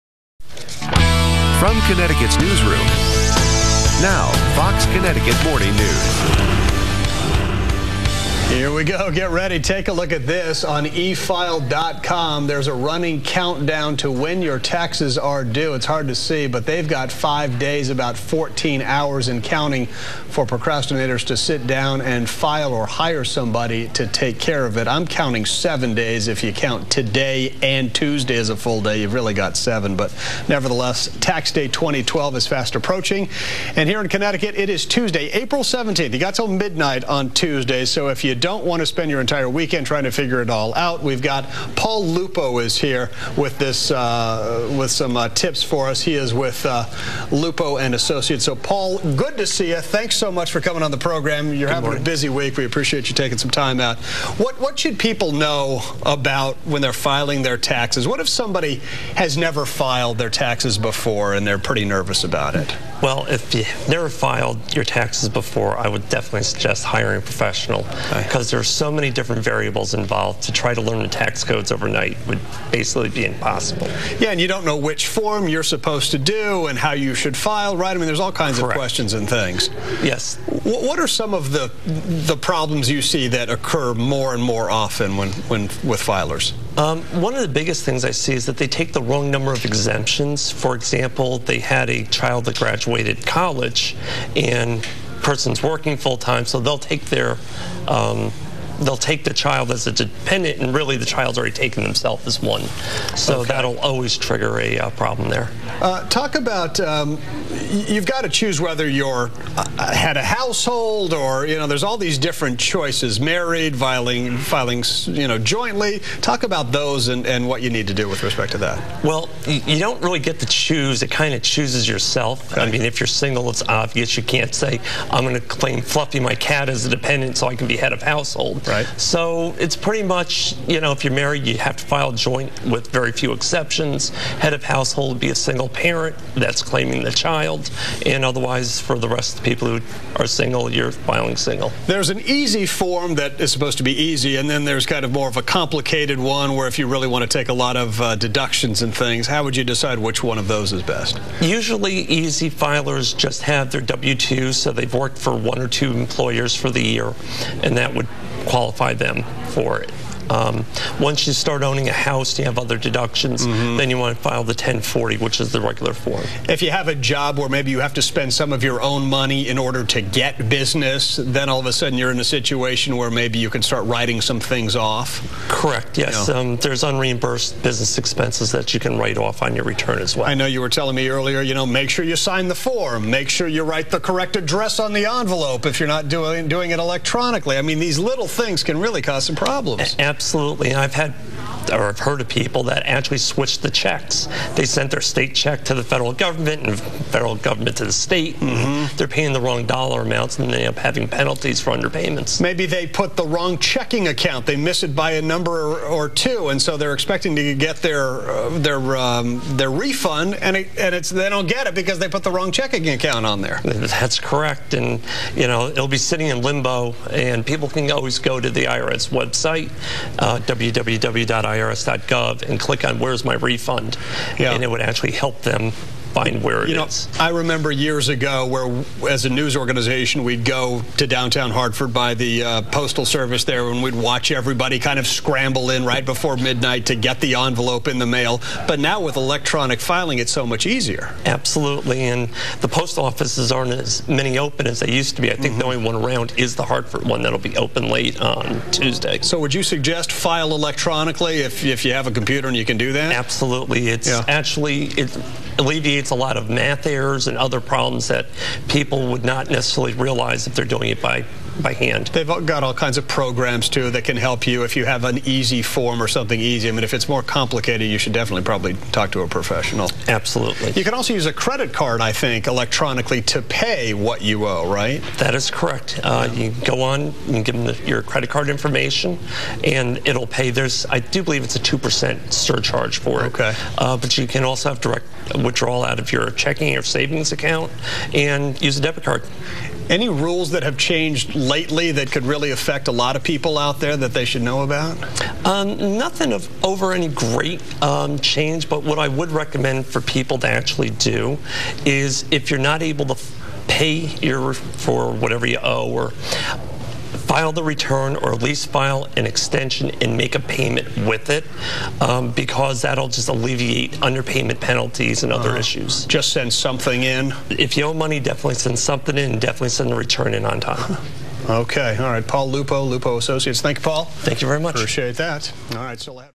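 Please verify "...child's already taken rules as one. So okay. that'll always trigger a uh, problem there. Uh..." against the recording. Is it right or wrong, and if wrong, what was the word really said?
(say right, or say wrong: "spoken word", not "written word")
wrong: "themselves", not "rules".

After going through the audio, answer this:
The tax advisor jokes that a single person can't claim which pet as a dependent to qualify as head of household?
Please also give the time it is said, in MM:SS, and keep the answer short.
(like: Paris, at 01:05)
Fluffy my cat, at 02:05.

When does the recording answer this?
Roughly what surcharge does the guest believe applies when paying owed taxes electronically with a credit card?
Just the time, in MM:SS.
04:41.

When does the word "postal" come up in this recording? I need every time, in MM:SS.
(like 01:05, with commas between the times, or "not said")
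03:52, 04:02.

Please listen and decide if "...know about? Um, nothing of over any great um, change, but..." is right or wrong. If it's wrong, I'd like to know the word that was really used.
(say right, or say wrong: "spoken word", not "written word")
right.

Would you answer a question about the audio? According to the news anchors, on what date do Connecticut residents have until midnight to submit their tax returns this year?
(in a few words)
Tuesday, April 17th.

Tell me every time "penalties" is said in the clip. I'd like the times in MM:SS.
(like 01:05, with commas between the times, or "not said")
03:21, 05:14.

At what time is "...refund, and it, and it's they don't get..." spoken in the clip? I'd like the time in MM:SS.
03:29.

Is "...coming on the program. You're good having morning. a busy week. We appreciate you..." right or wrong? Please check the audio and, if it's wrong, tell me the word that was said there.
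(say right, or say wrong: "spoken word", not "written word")
right.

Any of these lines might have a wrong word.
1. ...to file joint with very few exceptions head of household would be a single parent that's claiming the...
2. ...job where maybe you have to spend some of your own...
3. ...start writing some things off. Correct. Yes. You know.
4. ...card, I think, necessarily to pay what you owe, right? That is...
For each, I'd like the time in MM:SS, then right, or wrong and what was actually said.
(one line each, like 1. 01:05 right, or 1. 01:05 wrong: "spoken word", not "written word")
1. 02:11 right
2. 02:46 right
3. 02:53 right
4. 04:31 wrong: "electronically", not "necessarily".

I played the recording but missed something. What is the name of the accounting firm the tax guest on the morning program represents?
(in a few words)
Lupo and Associates.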